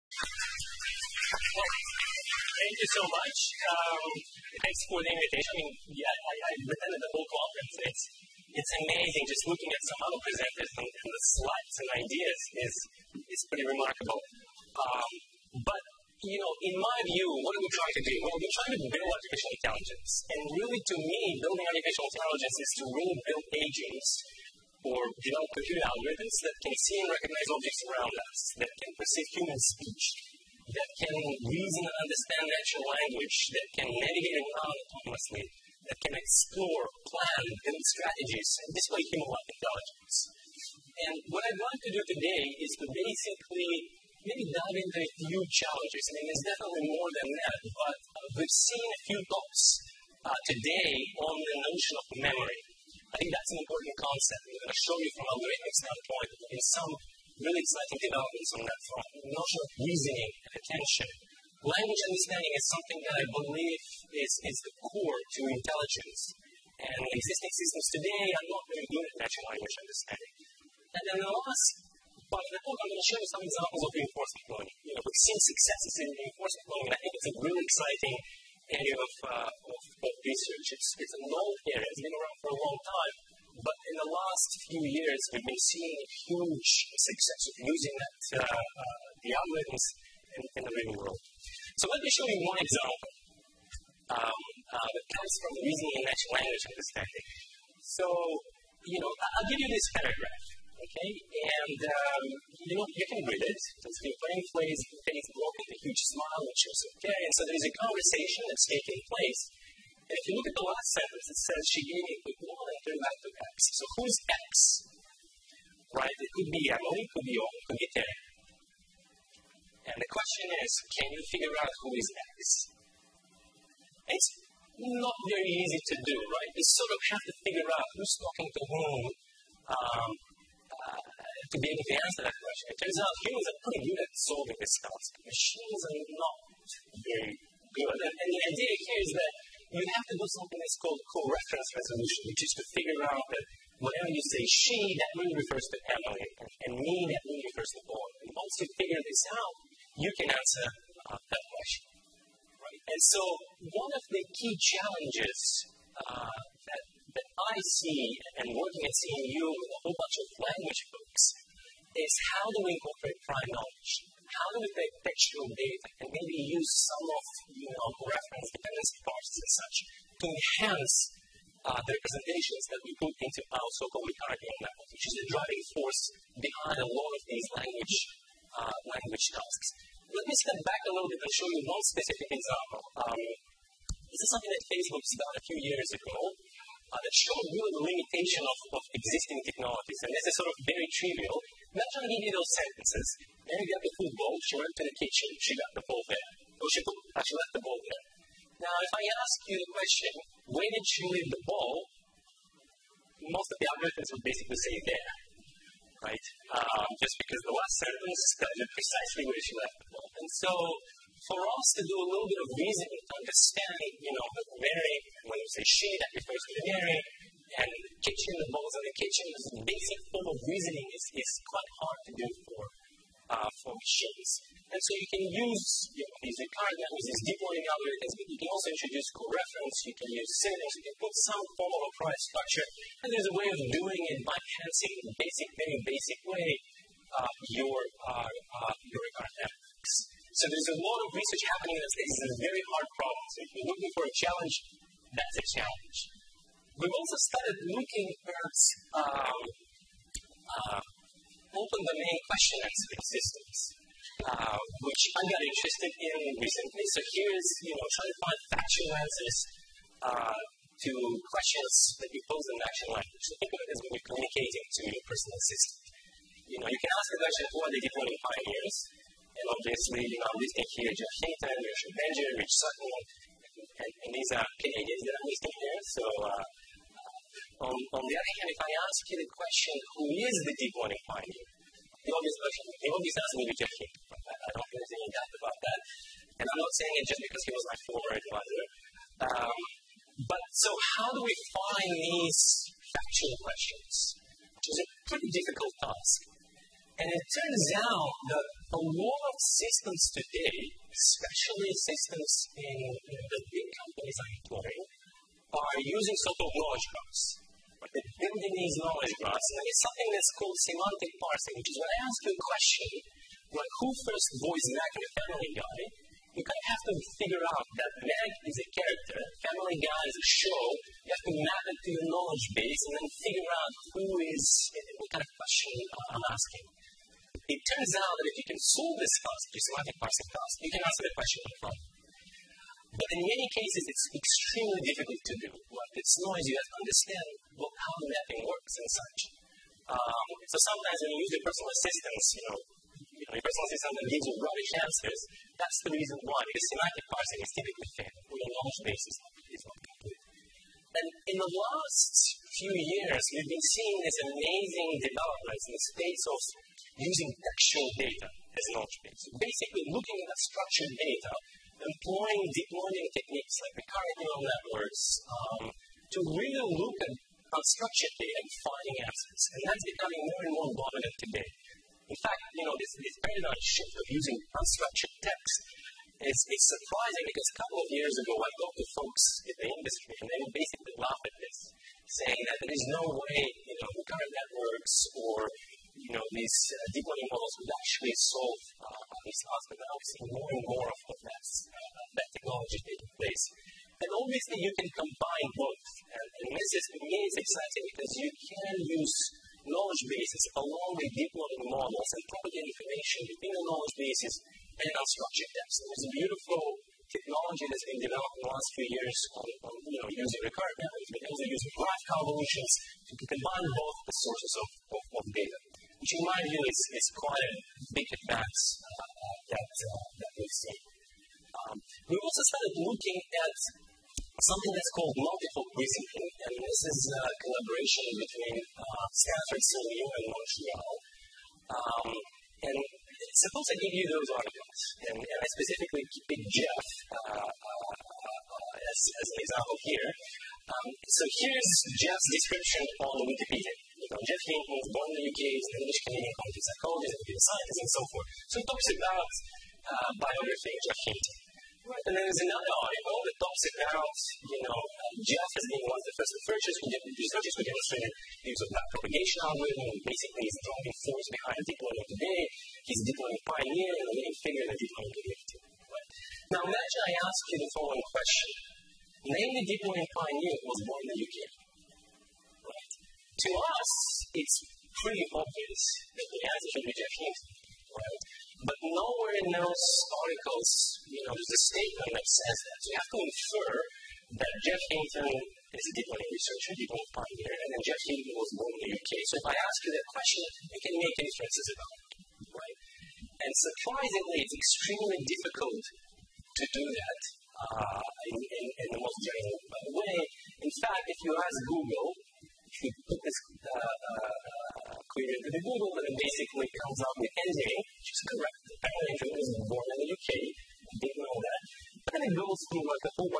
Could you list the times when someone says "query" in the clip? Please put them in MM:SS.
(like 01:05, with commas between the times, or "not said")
08:25.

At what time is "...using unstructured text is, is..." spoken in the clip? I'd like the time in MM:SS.
06:14.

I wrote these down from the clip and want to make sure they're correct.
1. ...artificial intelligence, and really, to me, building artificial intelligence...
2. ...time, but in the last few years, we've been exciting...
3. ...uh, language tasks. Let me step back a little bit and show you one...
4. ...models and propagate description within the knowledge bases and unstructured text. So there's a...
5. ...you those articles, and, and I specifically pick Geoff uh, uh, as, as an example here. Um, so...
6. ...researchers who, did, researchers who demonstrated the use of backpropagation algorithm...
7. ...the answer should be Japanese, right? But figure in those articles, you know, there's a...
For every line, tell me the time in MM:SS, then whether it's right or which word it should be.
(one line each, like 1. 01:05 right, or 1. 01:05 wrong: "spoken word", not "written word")
1. 00:19 right
2. 01:22 wrong: "seeing", not "exciting"
3. 02:58 right
4. 06:41 wrong: "information", not "description"
5. 07:14 right
6. 07:36 right
7. 07:56 wrong: "nowhere", not "figure".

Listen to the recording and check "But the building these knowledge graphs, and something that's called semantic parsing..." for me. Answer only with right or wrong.
right.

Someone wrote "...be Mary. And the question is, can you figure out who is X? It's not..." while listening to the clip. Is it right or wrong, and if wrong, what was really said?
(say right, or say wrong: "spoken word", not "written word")
wrong: "Terry", not "Mary".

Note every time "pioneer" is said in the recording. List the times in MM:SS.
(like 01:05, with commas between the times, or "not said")
04:28, 04:41, 07:43, 07:50, 08:07.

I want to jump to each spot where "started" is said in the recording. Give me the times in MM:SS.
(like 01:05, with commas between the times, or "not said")
03:05, 04:07, 07:02.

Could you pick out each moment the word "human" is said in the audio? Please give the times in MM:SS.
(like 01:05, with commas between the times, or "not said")
00:29, 00:39, 02:13.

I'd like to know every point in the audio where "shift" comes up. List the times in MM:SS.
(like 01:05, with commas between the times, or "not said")
06:13.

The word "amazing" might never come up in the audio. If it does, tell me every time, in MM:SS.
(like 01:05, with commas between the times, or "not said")
00:08, 05:54.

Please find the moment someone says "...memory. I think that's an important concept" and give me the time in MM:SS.
00:52.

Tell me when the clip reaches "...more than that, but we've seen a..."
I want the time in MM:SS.
00:46.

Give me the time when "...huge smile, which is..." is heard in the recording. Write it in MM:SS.
01:45.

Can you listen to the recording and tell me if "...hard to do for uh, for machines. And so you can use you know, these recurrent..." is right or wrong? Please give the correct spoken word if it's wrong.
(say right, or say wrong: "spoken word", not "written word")
right.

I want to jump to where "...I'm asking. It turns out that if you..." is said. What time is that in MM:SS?
05:26.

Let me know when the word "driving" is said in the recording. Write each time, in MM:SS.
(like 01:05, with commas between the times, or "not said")
02:55, 07:40.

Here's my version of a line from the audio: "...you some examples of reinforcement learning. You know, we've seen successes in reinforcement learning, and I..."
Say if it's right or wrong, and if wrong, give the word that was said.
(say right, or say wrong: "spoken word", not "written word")
right.